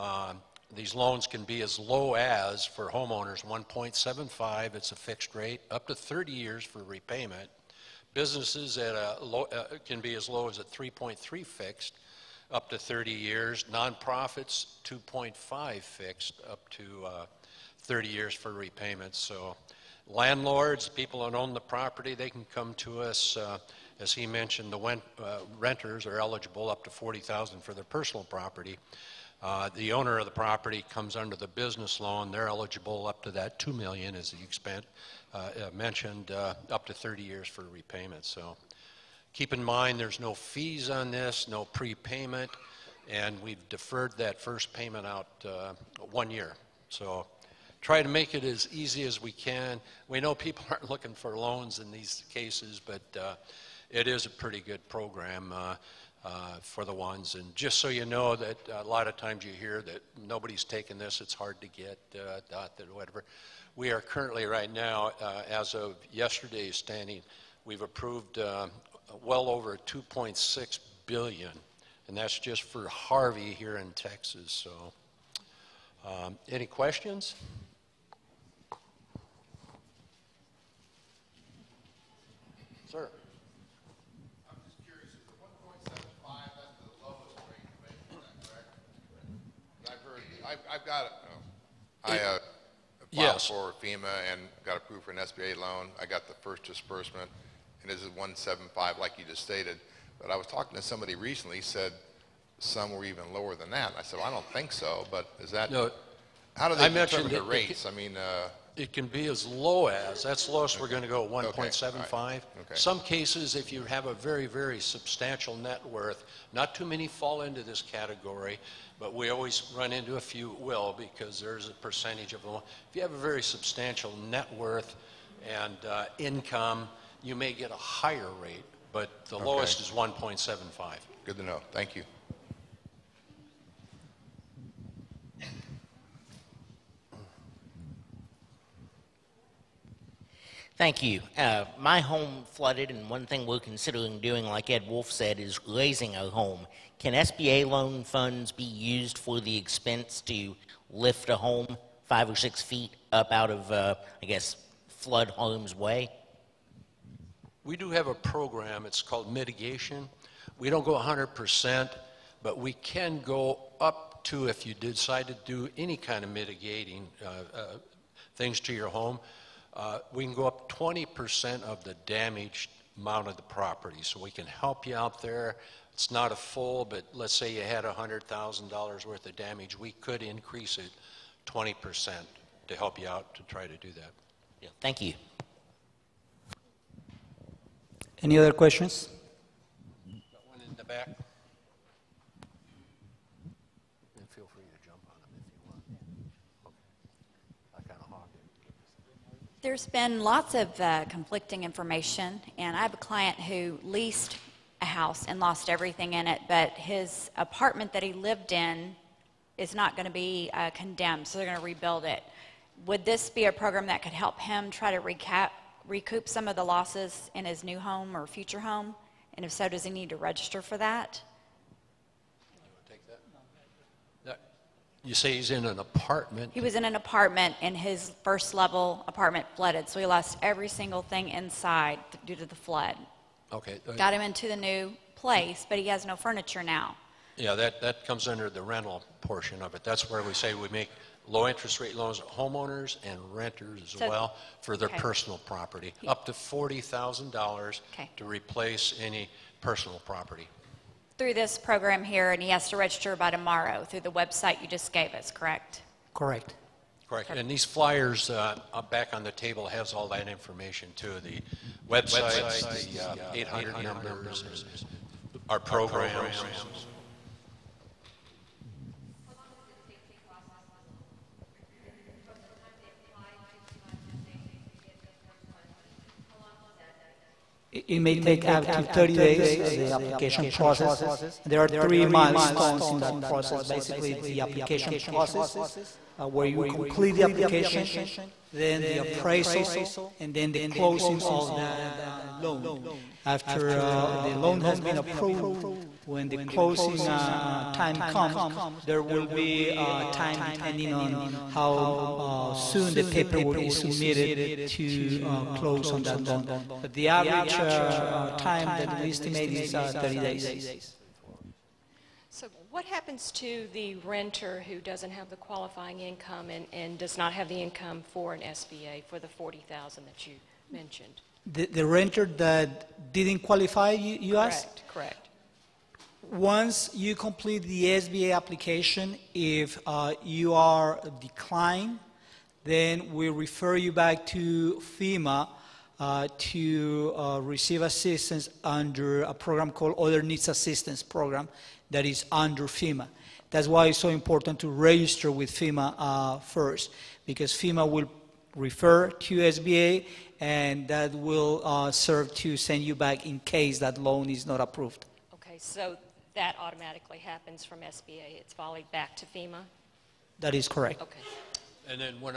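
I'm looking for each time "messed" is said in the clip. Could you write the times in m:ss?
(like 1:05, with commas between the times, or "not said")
not said.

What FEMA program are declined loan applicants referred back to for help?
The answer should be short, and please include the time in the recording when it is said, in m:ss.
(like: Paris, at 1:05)
Other Needs Assistance Program, at 5:39.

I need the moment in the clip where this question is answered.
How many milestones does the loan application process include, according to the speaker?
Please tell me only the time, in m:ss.
4:41.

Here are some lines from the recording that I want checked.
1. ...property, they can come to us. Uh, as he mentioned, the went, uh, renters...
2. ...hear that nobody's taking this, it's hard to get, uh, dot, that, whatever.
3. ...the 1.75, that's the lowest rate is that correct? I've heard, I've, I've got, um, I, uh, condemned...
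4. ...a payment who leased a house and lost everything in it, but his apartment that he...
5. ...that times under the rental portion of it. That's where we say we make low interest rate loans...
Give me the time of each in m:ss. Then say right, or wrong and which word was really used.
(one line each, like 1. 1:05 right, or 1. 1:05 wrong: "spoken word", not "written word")
1. 0:21 right
2. 0:59 right
3. 1:25 wrong: "filed", not "condemned"
4. 3:22 wrong: "client", not "payment"
5. 3:57 wrong: "comes", not "times".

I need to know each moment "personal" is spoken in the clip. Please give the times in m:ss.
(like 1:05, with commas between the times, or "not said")
0:27, 4:04, 4:09.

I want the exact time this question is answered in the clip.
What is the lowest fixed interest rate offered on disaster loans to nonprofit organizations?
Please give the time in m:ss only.
0:14.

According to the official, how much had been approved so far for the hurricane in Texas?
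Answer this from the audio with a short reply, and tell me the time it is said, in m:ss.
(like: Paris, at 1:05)
over 2.6 billion, at 1:09.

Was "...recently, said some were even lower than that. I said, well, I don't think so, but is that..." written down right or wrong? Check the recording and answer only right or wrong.
right.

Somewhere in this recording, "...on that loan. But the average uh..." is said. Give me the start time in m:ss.
5:05.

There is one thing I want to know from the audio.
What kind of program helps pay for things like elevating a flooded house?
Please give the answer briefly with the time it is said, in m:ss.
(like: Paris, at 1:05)
mitigation, at 2:39.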